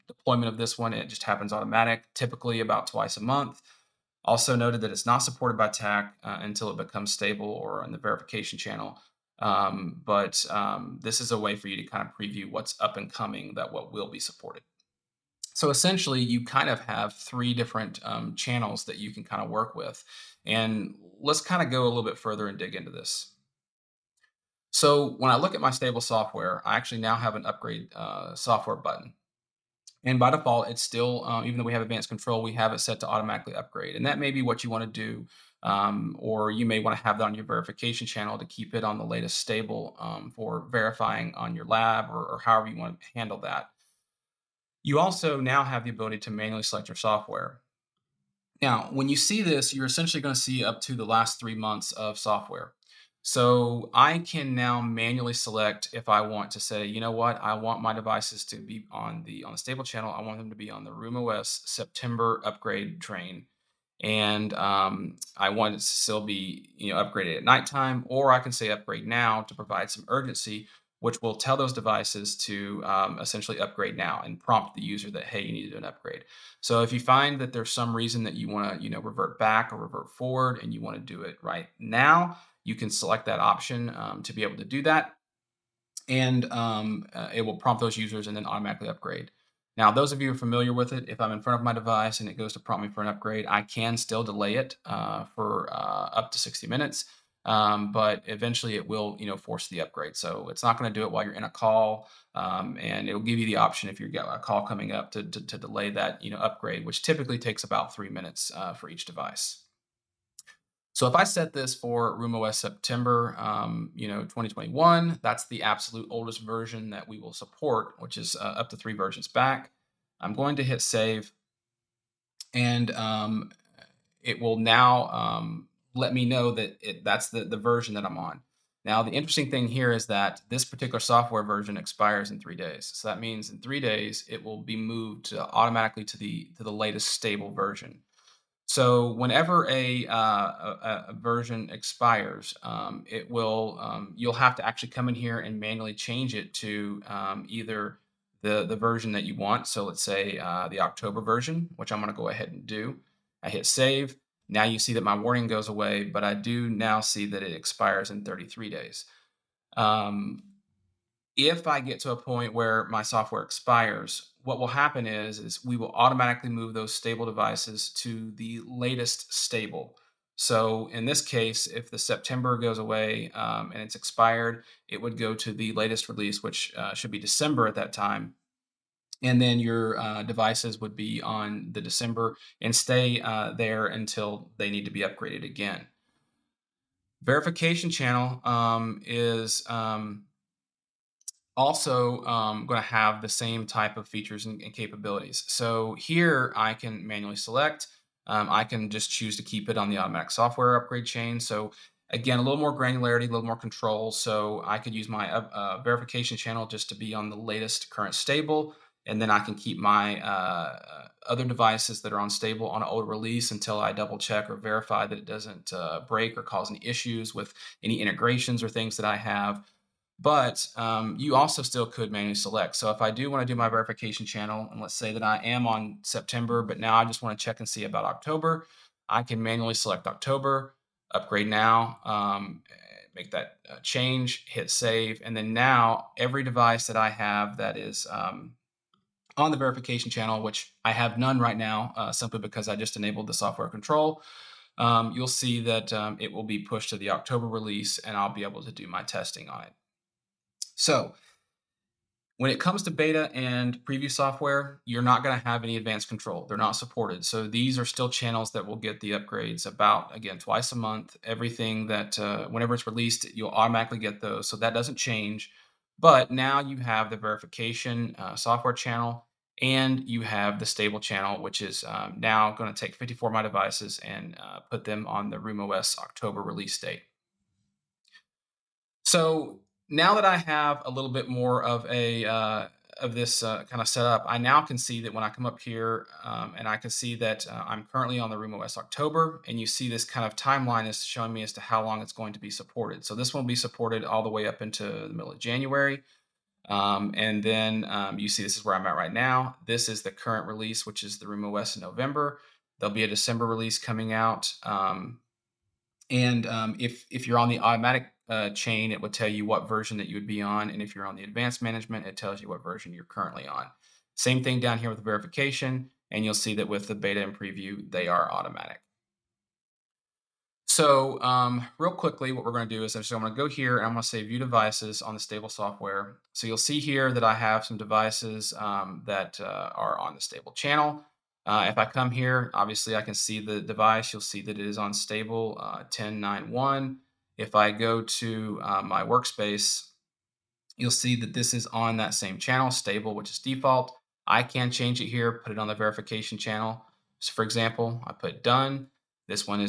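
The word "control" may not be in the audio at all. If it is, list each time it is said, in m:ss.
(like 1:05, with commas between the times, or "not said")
0:32, 3:23, 4:03, 4:16.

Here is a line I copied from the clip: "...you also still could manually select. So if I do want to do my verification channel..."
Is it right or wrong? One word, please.
right.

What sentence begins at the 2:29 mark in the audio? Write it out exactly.
So let's say uh, the October version, which I'm going to go ahead and do.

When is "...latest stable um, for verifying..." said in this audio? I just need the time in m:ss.
0:39.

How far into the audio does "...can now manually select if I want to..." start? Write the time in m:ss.
0:54.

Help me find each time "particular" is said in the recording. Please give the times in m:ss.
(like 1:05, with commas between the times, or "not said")
2:10.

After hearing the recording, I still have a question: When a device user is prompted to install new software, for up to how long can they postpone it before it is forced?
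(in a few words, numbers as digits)
60 minutes.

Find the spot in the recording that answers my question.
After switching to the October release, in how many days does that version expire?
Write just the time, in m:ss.
2:38.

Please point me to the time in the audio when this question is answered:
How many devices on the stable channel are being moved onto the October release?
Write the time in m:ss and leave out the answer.
4:32.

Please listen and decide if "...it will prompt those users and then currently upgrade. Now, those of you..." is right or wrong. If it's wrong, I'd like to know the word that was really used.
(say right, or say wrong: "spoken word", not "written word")
wrong: "automatically", not "currently".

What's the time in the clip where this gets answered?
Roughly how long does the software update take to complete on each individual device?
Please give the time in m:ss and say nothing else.
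1:47.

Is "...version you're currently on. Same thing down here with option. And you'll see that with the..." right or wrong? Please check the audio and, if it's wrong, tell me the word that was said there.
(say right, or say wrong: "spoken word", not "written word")
wrong: "verification", not "option".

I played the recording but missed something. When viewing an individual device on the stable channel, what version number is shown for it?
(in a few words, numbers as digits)
1091.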